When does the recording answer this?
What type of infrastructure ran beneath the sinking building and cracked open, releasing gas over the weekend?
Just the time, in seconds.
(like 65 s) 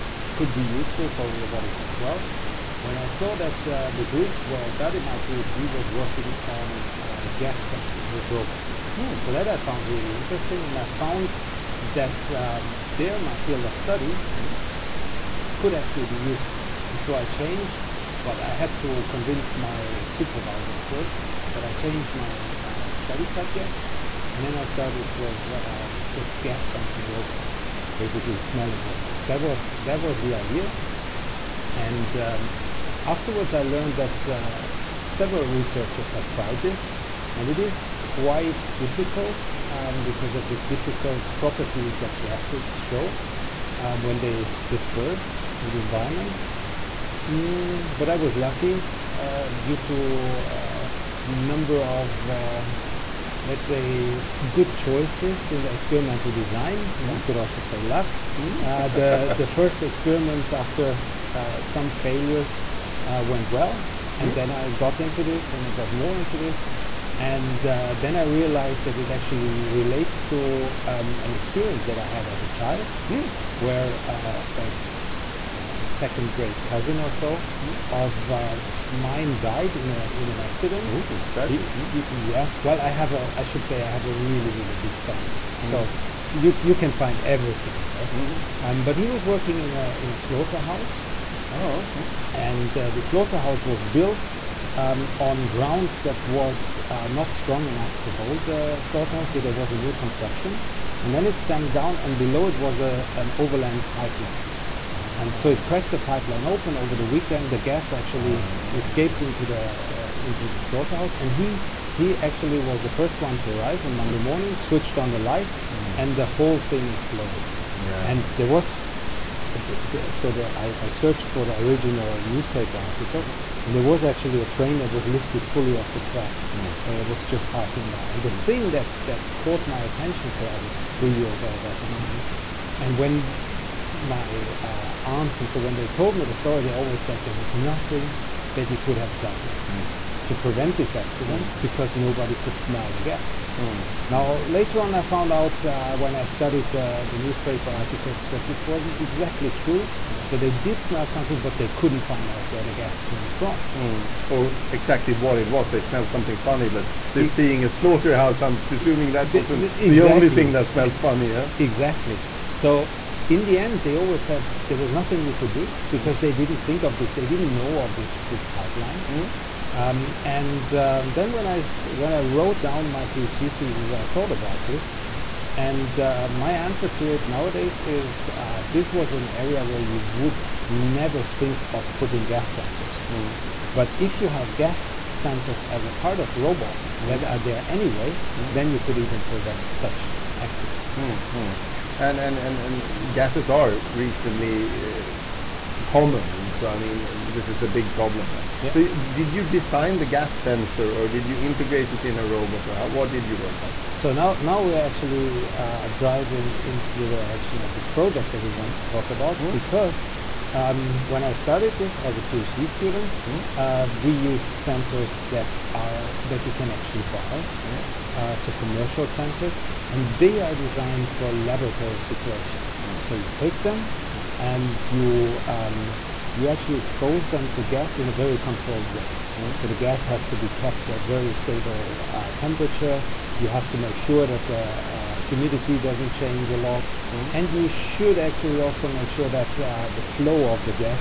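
103 s.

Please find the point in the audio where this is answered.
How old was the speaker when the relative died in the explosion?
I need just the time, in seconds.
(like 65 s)
130 s.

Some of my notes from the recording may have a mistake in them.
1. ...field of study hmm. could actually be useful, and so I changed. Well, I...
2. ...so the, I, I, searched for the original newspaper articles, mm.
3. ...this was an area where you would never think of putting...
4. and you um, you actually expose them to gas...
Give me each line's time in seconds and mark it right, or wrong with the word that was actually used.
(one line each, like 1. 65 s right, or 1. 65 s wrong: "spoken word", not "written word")
1. 13 s right
2. 120 s right
3. 178 s right
4. 224 s right.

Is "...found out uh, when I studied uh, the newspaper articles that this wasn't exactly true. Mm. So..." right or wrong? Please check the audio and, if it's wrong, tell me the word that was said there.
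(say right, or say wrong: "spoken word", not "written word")
right.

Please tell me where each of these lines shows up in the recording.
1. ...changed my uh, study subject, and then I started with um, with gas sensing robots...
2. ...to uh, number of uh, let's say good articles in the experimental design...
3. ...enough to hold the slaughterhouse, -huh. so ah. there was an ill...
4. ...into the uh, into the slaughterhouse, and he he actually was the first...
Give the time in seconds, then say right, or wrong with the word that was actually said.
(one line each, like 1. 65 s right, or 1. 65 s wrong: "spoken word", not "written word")
1. 21 s right
2. 49 s wrong: "choices", not "articles"
3. 97 s right
4. 109 s right.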